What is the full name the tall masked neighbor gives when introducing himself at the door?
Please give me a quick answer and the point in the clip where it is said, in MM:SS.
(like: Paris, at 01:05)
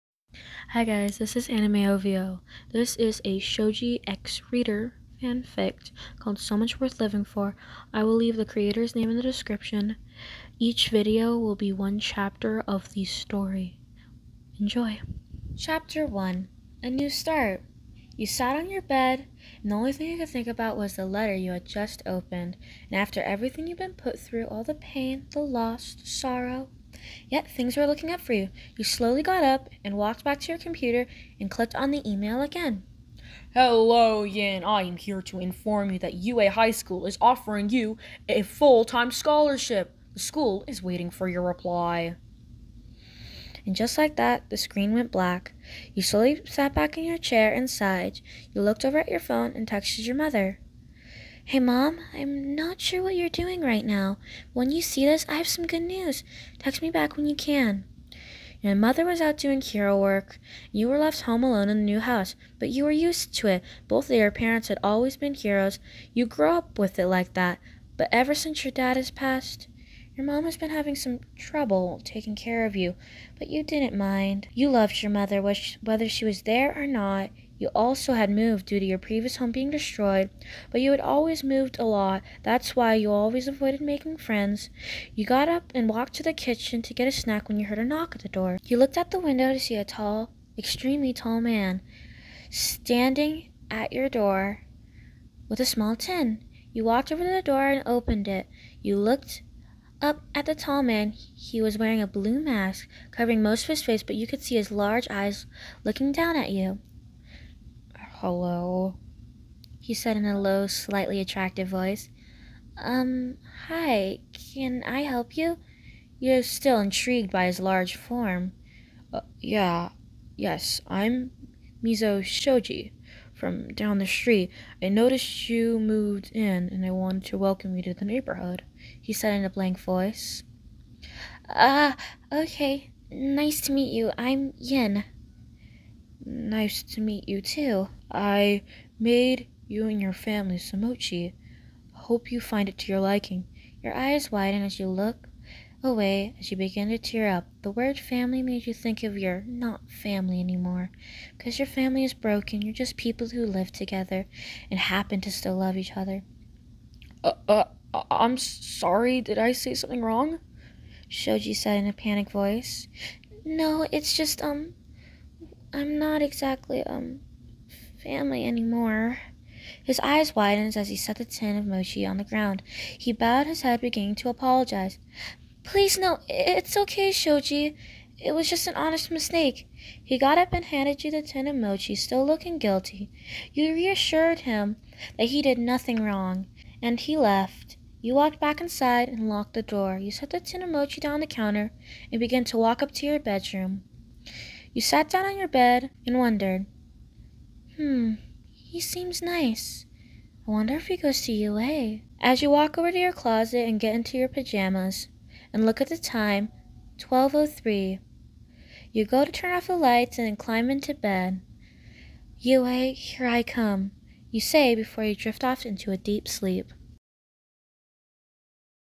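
Mezo Shoji, at 02:01.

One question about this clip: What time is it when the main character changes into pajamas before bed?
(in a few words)
12:03.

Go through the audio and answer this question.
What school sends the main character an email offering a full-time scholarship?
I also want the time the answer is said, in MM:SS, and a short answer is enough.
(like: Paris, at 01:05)
UA High School, at 00:36.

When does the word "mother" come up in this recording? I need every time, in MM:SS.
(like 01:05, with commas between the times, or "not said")
00:50, 00:58, 01:15.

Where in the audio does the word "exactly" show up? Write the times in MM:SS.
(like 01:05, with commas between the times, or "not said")
02:46.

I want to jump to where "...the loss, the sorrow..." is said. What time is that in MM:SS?
00:25.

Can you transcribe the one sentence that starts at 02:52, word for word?
He bowed his head, beginning to apologize.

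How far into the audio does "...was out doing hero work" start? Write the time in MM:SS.
00:59.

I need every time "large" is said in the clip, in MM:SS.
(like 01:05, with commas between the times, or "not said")
01:44, 01:57.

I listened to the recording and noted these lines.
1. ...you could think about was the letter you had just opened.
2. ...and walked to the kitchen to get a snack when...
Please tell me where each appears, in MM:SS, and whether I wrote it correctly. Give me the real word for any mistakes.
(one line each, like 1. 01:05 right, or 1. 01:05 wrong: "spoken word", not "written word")
1. 00:20 right
2. 01:25 right.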